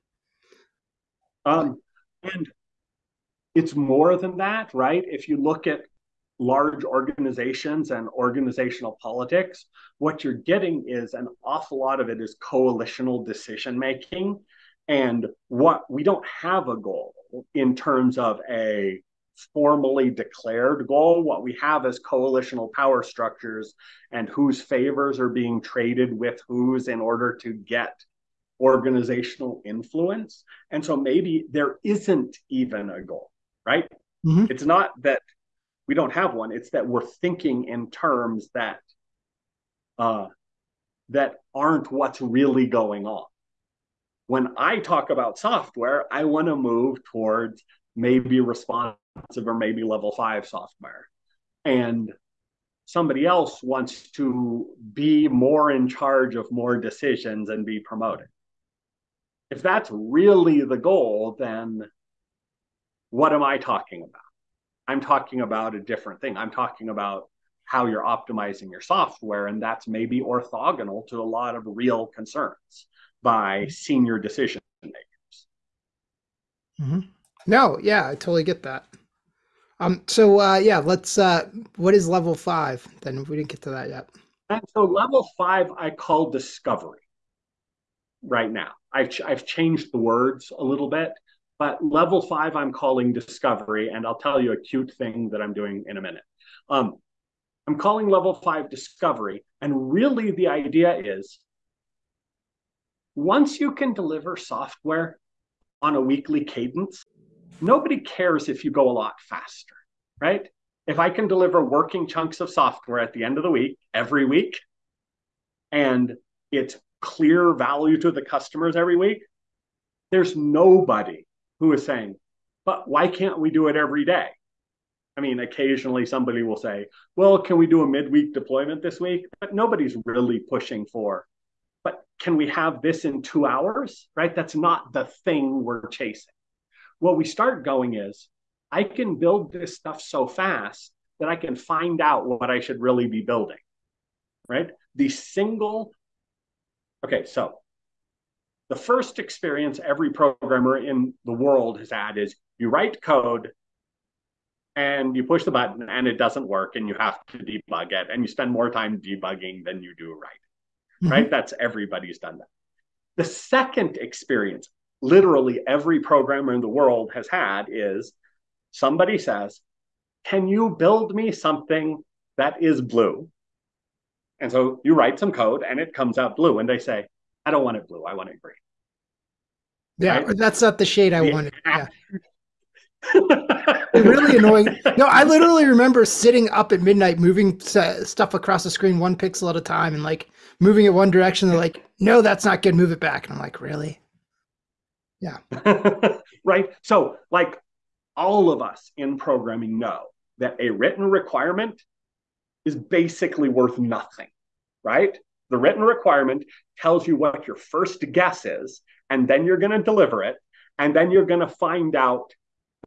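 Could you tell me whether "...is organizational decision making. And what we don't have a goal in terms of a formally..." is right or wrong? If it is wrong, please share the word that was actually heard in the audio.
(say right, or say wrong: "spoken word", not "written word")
wrong: "coalitional", not "organizational".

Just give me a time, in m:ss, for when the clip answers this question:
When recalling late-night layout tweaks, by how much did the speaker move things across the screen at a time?
3:08.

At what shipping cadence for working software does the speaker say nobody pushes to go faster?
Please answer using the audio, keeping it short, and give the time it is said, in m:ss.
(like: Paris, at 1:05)
Weekly, at 1:46.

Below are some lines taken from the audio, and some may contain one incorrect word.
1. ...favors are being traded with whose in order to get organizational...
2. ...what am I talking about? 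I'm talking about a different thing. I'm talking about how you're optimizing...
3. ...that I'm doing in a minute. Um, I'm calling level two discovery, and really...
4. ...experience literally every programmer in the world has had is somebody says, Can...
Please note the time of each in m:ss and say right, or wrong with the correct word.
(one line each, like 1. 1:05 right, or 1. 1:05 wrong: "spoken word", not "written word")
1. 0:24 right
2. 1:03 right
3. 1:35 wrong: "five", not "two"
4. 2:43 right.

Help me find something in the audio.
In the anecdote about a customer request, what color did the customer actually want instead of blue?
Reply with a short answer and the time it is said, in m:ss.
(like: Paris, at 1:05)
Green, at 2:58.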